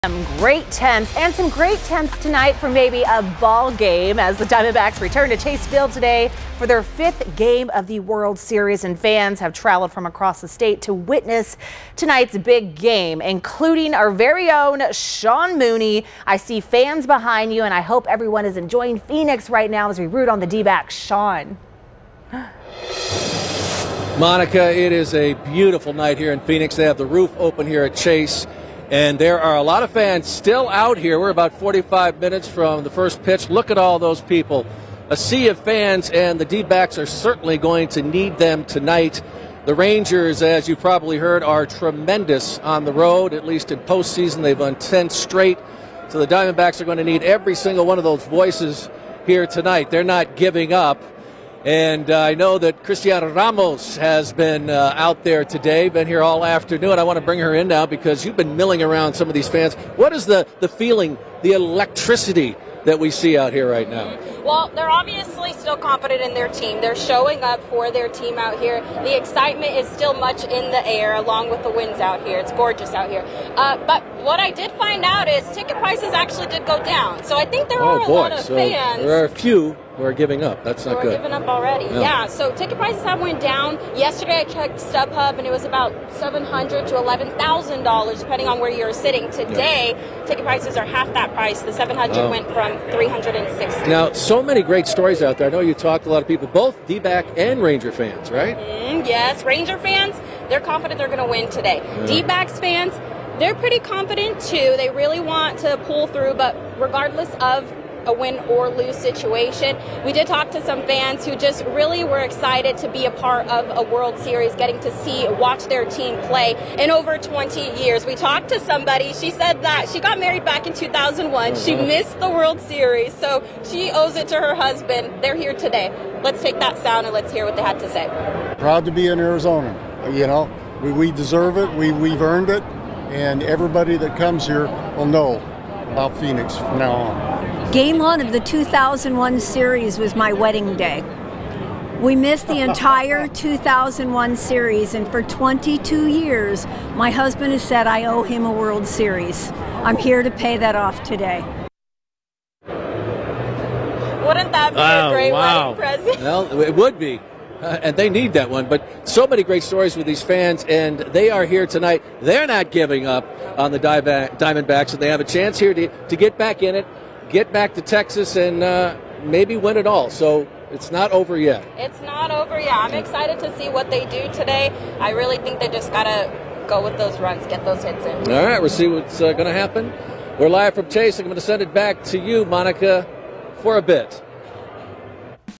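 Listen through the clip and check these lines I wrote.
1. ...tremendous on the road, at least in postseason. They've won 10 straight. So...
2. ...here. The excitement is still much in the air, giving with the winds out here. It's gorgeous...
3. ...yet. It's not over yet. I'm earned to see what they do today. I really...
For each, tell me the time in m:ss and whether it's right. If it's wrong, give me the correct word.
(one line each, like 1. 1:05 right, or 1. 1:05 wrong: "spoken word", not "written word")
1. 0:41 right
2. 1:08 wrong: "along", not "giving"
3. 2:51 wrong: "excited", not "earned".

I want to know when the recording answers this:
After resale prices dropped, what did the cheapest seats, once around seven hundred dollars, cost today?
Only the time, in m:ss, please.
1:32.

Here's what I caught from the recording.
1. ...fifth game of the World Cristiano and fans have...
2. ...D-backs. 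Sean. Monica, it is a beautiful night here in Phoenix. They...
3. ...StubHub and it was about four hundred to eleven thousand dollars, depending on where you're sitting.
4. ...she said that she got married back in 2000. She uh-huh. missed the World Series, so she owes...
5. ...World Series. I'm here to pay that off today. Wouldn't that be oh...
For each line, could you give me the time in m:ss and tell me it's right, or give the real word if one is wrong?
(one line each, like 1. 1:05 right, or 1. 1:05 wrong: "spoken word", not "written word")
1. 0:06 wrong: "Series", not "Cristiano"
2. 0:20 right
3. 1:24 wrong: "seven", not "four"
4. 1:59 wrong: "2001", not "2000"
5. 2:28 right.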